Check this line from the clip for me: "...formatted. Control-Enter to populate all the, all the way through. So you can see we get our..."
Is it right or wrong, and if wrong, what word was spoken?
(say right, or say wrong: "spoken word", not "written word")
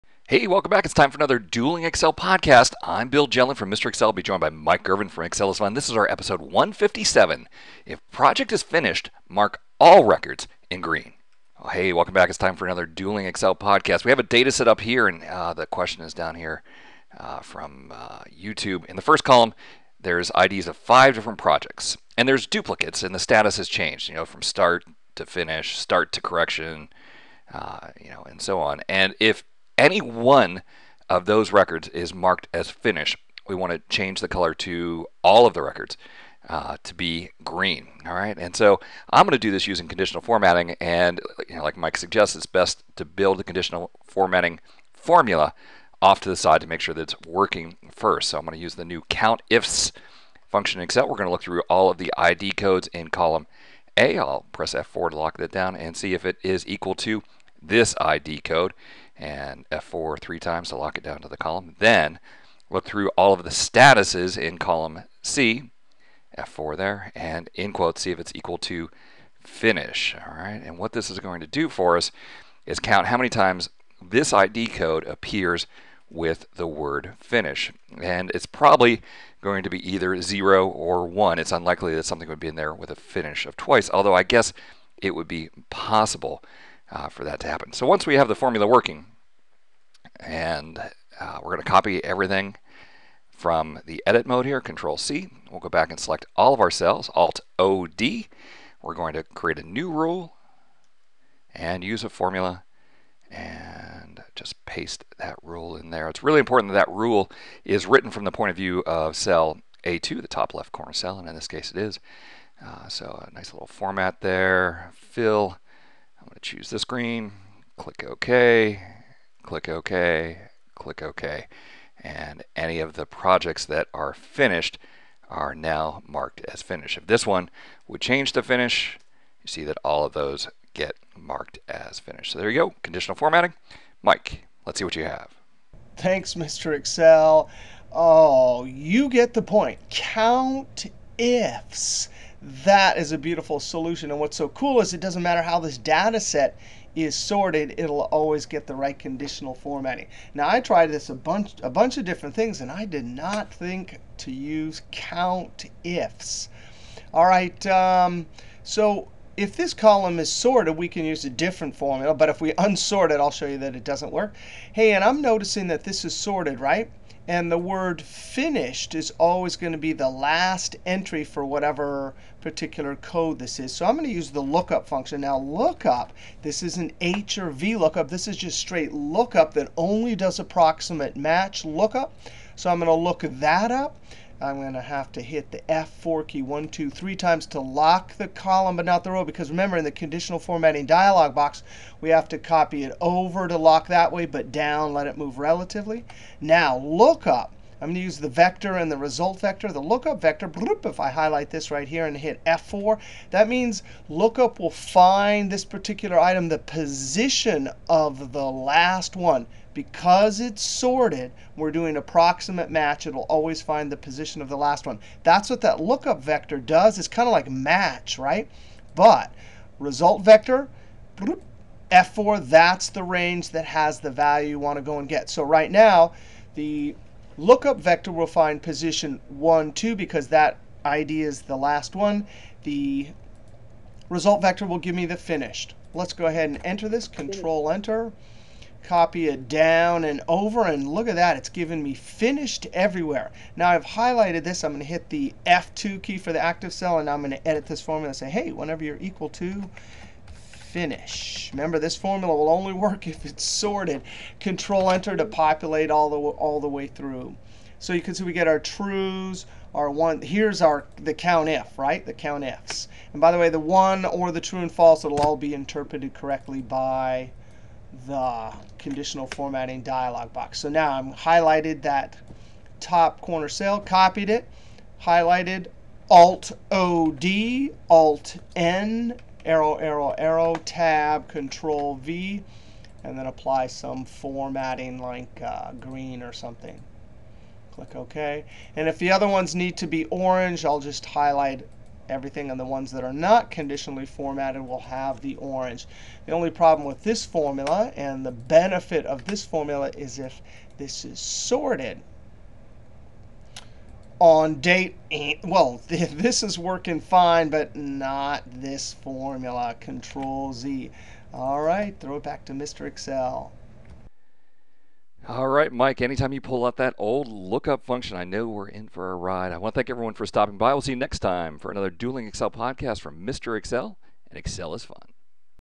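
wrong: "sorted", not "formatted".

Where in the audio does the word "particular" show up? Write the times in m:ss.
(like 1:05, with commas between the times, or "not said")
2:52, 3:25.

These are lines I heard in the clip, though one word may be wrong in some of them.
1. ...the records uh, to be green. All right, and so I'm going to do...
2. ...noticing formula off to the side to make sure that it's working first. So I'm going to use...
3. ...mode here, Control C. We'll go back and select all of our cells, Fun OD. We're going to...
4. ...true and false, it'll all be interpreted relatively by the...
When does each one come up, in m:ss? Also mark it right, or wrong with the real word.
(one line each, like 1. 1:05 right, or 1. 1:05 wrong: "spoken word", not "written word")
1. 0:35 right
2. 0:44 wrong: "formatting", not "noticing"
3. 1:34 wrong: "Alt", not "Fun"
4. 4:24 wrong: "correctly", not "relatively".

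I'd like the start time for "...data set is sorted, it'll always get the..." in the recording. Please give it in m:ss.
2:25.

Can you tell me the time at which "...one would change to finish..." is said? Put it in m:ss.
2:07.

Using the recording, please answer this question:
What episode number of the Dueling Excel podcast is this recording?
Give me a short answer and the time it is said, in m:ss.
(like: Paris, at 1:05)
157, at 0:06.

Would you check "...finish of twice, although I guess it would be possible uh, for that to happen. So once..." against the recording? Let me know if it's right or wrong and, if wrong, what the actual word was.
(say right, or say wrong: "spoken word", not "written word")
right.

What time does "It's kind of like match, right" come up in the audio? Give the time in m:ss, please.
3:36.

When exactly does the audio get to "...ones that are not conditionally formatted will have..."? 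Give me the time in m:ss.
4:52.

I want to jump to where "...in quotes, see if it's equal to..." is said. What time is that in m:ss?
1:07.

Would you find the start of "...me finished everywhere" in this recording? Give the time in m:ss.
4:01.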